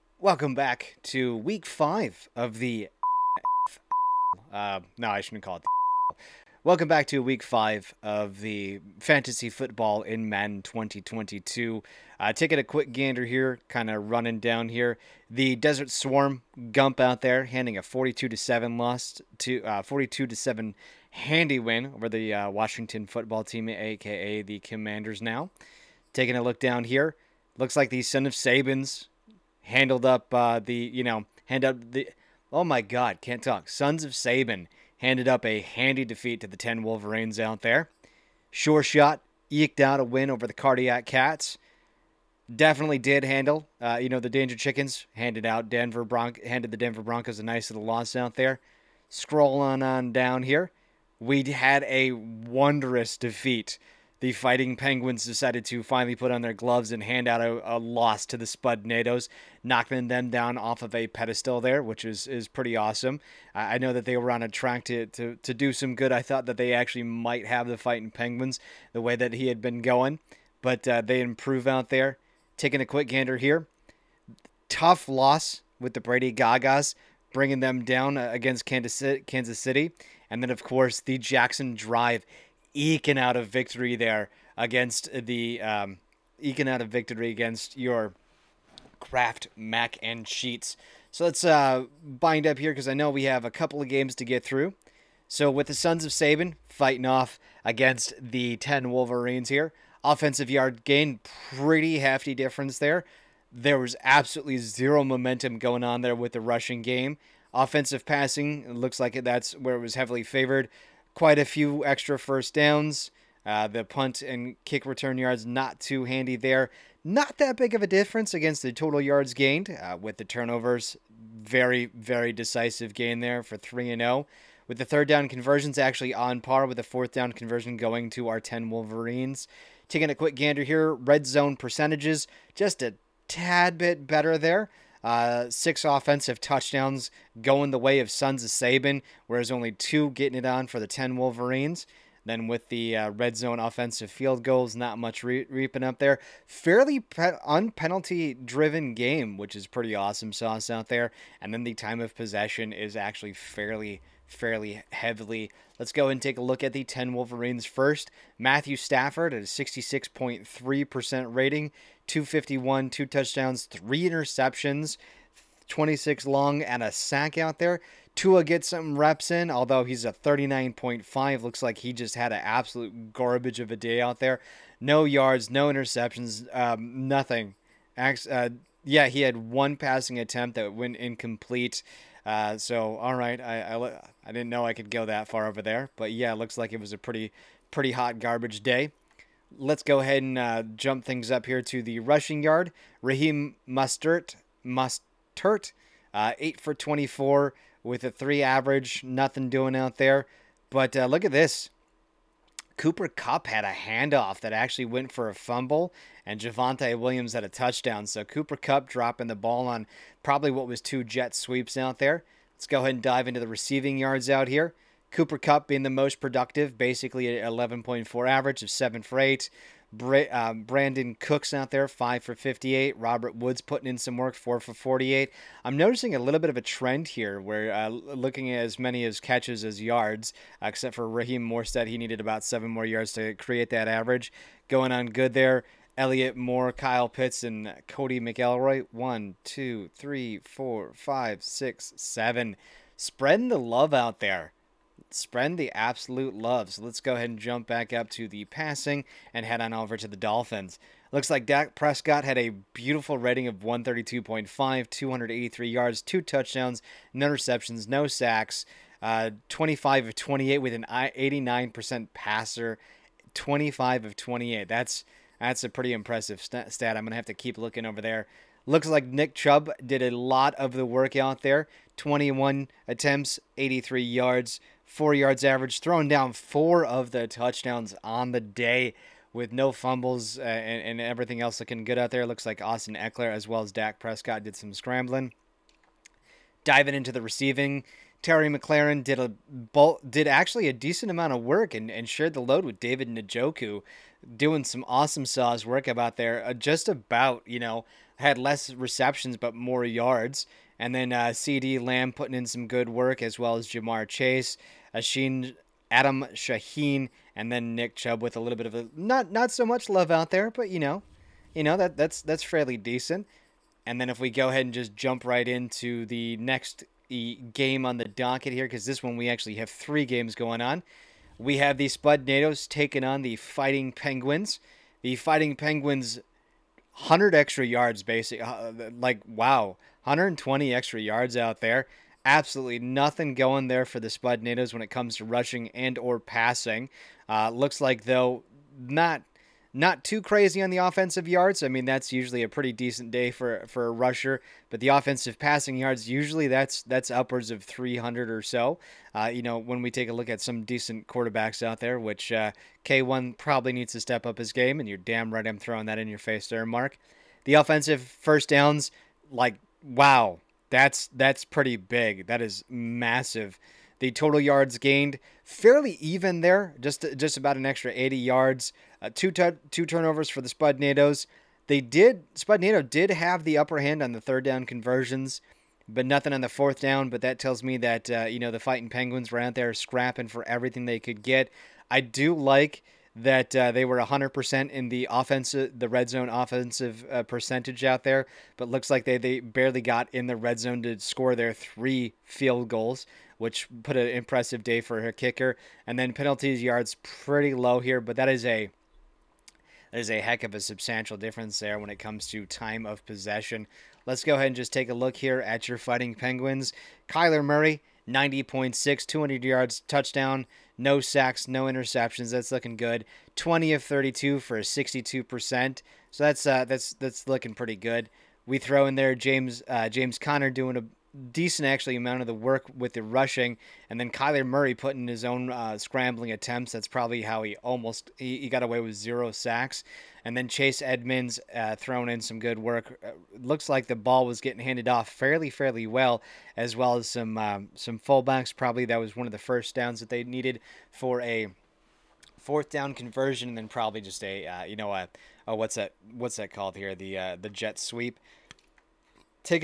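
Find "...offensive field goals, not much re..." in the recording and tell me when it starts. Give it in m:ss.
2:23.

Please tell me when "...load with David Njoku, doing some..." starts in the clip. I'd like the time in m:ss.
4:52.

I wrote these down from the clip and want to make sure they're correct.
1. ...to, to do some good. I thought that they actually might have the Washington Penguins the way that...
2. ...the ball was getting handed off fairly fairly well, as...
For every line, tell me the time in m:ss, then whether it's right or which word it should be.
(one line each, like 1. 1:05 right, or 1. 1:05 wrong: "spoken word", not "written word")
1. 1:05 wrong: "Fighting", not "Washington"
2. 7:13 right.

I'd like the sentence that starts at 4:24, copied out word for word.
That's that's a pretty impressive st- stat.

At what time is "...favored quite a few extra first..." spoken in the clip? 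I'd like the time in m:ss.
1:50.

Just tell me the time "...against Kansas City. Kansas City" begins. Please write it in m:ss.
1:18.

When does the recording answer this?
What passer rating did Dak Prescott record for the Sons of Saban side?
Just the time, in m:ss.
4:13.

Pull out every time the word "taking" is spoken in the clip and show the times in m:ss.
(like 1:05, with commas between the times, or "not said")
0:12, 0:26, 1:12, 2:09, 5:22.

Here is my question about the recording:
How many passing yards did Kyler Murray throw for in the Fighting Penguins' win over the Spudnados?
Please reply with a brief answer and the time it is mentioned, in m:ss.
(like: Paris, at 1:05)
200, at 6:49.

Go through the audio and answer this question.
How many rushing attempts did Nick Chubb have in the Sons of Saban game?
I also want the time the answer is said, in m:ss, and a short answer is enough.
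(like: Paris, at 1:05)
21, at 4:31.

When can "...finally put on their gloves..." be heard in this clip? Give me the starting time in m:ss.
0:55.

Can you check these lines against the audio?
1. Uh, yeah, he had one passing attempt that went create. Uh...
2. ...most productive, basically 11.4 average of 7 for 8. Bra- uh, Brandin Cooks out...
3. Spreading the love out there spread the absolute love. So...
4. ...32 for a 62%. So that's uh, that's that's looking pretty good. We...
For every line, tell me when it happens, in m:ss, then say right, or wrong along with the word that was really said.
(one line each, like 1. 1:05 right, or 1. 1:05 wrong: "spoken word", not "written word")
1. 2:57 wrong: "incomplete", not "create"
2. 3:35 right
3. 4:02 right
4. 6:53 right.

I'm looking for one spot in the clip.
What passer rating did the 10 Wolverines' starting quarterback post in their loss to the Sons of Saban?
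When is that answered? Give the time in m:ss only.
2:39.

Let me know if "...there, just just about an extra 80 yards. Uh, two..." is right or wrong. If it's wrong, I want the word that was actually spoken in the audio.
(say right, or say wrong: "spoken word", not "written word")
right.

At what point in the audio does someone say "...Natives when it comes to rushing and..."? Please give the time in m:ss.
5:34.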